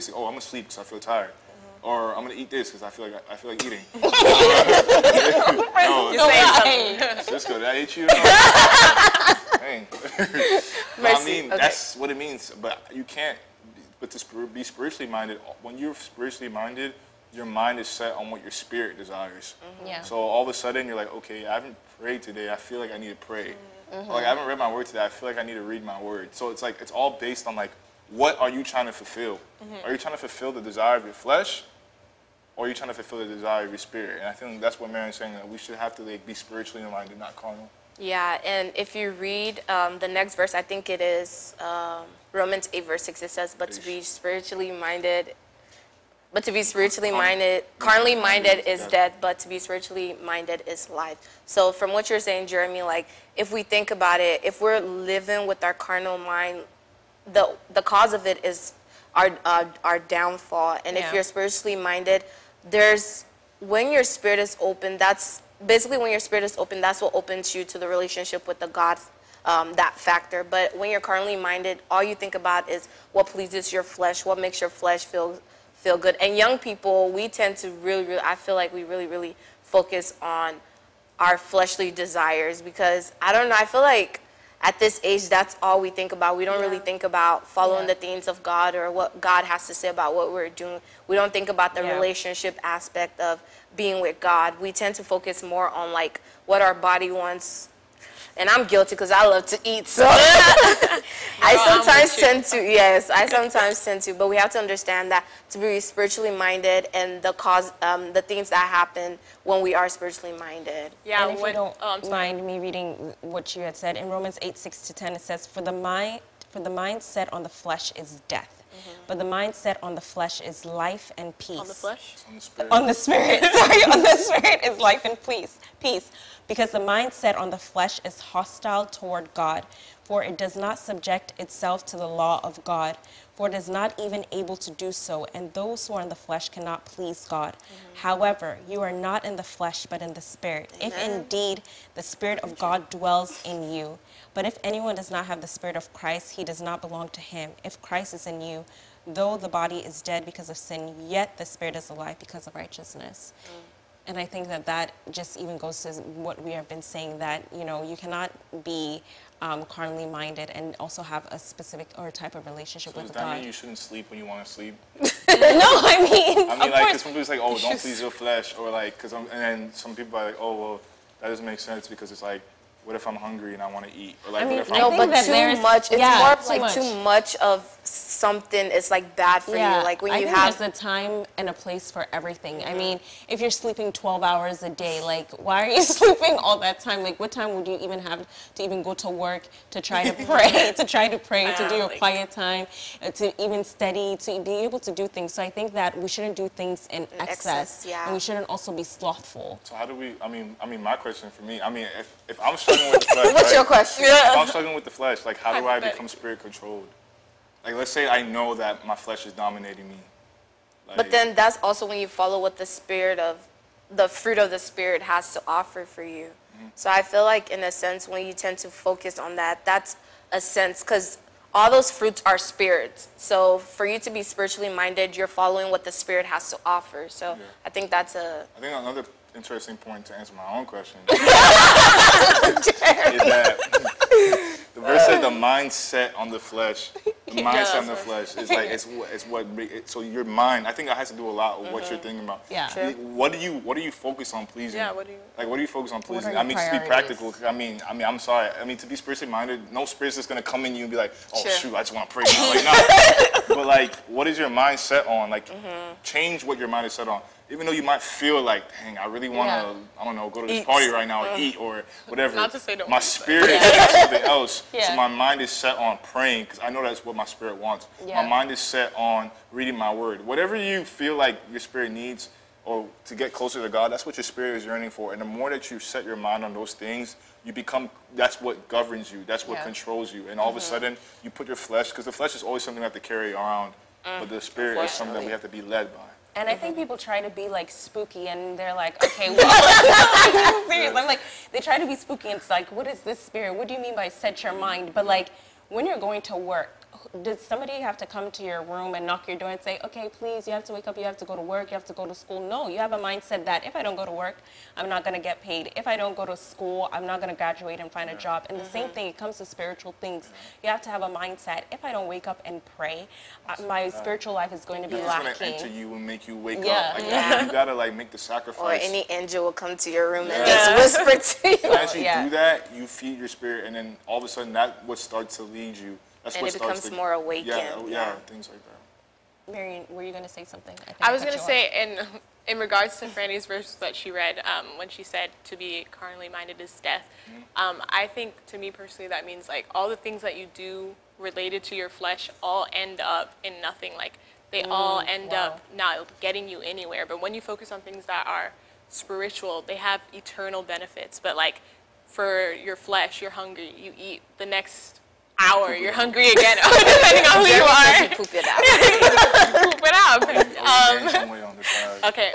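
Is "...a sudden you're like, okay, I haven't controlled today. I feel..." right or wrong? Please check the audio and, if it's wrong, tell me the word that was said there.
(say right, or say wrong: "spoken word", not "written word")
wrong: "prayed", not "controlled".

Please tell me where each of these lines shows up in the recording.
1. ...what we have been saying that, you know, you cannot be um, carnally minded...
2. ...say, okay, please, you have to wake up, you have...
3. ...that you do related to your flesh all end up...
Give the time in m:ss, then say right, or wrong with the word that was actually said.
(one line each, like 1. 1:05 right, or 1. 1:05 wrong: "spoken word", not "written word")
1. 2:36 right
2. 4:59 right
3. 5:40 right.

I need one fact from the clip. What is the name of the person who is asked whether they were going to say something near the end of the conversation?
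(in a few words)
Marion.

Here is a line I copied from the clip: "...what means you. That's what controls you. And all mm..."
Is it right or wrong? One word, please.
wrong.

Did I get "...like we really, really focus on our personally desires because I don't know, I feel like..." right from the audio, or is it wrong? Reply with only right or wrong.
wrong.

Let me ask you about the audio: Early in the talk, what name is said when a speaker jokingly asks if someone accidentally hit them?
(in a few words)
Cisco.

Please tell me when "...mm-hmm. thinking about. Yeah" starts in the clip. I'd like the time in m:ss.
4:01.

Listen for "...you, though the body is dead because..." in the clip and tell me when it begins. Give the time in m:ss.
2:28.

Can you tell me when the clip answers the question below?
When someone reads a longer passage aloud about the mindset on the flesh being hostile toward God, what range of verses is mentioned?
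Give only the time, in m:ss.
1:54.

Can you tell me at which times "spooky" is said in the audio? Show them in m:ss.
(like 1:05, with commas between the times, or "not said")
4:47, 4:51.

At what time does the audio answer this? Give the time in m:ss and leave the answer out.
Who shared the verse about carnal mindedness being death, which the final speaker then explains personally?
5:33.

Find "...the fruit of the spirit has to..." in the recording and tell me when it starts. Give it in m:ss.
3:33.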